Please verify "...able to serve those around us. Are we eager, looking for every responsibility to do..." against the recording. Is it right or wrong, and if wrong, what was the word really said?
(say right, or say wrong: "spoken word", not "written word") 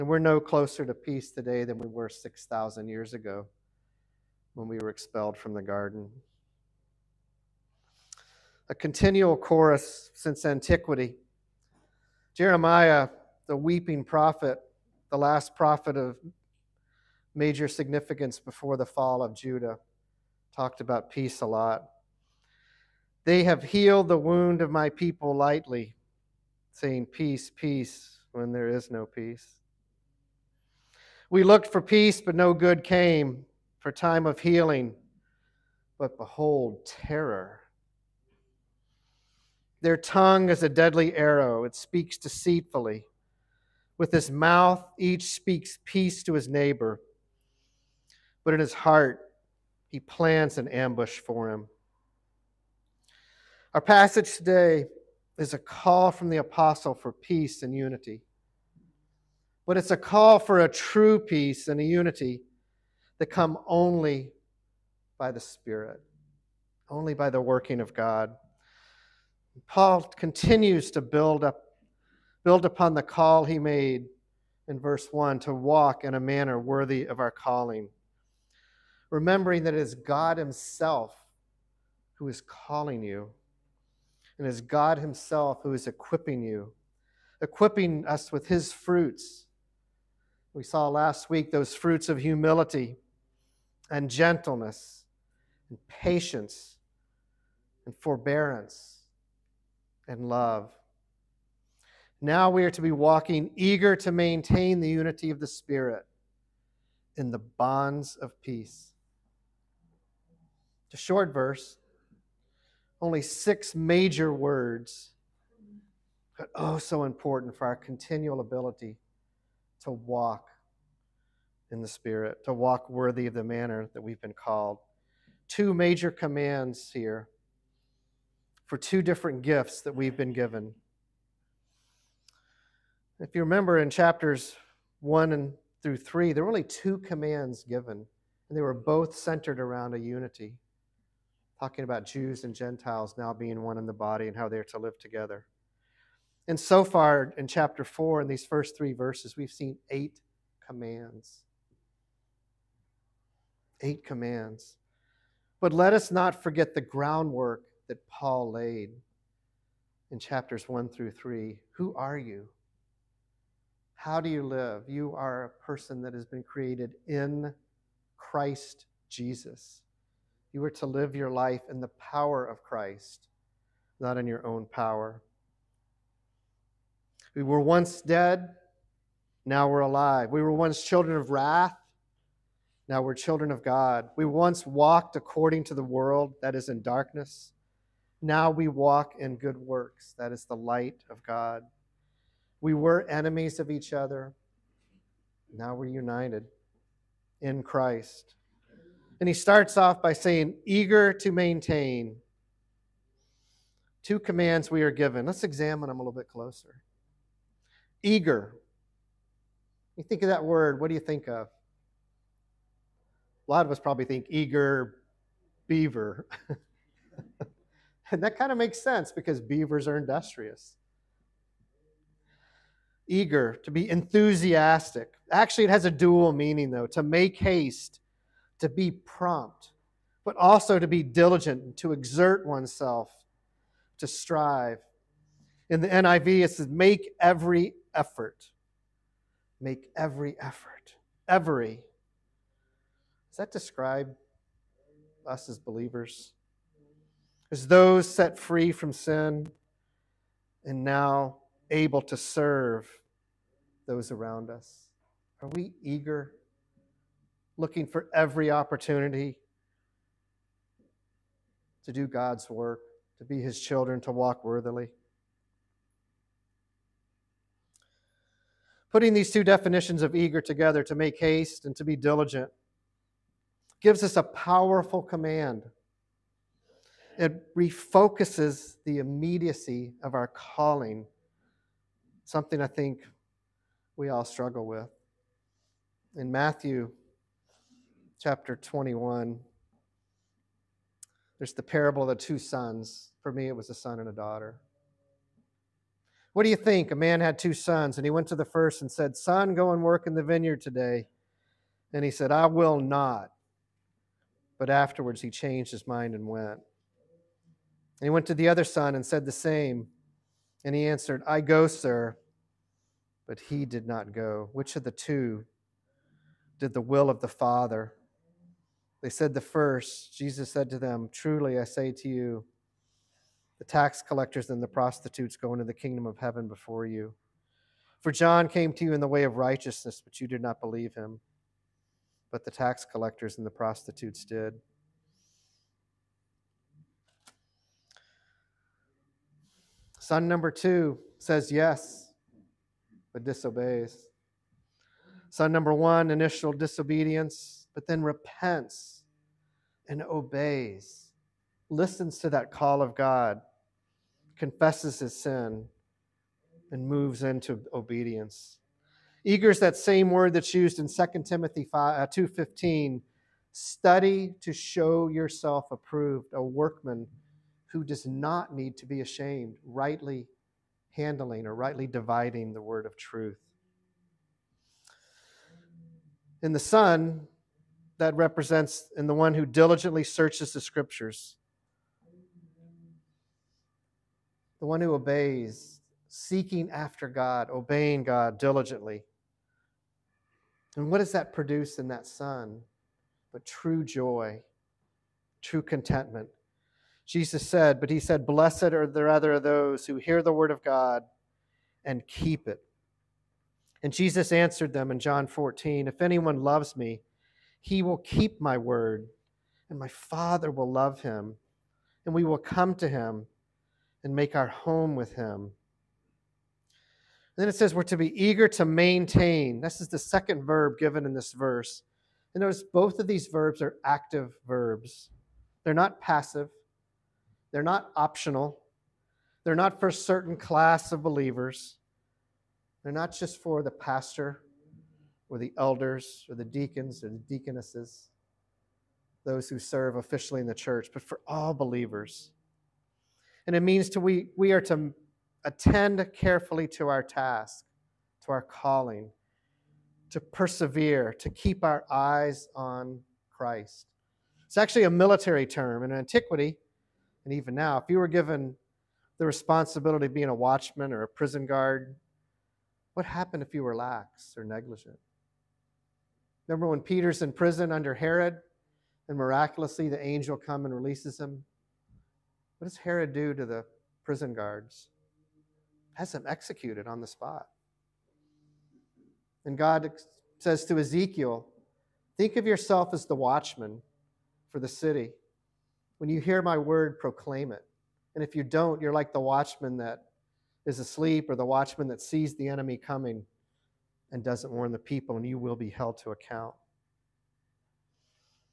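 wrong: "opportunity", not "responsibility".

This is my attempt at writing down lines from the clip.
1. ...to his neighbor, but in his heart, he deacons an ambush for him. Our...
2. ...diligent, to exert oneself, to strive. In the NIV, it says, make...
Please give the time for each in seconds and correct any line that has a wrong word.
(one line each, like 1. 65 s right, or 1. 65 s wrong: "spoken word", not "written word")
1. 46 s wrong: "plans", not "deacons"
2. 231 s right.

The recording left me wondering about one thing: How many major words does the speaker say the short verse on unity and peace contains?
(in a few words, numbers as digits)
6.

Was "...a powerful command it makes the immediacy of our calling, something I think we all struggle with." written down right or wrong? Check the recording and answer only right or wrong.
wrong.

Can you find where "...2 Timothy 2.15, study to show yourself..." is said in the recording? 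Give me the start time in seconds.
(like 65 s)
361 s.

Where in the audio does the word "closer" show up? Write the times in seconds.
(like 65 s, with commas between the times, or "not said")
0 s, 206 s.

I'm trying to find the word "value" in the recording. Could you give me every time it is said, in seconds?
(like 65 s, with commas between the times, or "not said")
not said.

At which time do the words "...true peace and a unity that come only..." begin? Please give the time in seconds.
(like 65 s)
60 s.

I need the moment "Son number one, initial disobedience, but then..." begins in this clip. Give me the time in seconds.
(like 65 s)
345 s.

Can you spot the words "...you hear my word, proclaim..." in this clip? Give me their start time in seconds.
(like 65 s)
486 s.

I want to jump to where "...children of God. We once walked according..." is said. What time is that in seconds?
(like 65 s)
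183 s.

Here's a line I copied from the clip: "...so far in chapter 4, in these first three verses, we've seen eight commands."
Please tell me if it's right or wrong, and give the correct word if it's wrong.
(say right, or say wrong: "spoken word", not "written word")
right.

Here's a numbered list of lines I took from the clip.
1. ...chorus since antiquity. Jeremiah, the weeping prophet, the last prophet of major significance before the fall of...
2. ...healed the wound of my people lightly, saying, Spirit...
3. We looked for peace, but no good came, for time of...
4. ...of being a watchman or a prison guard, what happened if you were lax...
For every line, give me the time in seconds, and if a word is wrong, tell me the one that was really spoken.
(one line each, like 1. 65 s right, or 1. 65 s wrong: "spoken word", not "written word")
1. 9 s right
2. 23 s wrong: "Peace", not "Spirit"
3. 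31 s right
4. 460 s right.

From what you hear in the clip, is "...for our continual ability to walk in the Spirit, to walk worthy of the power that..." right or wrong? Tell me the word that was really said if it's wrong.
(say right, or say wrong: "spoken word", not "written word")
wrong: "manner", not "power".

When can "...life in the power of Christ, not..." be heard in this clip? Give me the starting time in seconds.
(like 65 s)
171 s.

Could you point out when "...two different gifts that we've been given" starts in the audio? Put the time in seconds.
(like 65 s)
128 s.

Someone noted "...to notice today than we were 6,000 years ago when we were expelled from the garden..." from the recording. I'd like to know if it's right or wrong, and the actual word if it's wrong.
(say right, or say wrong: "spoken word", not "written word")
wrong: "peace", not "notice".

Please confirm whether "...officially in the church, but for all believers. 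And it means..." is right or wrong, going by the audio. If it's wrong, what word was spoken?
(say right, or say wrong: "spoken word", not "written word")
right.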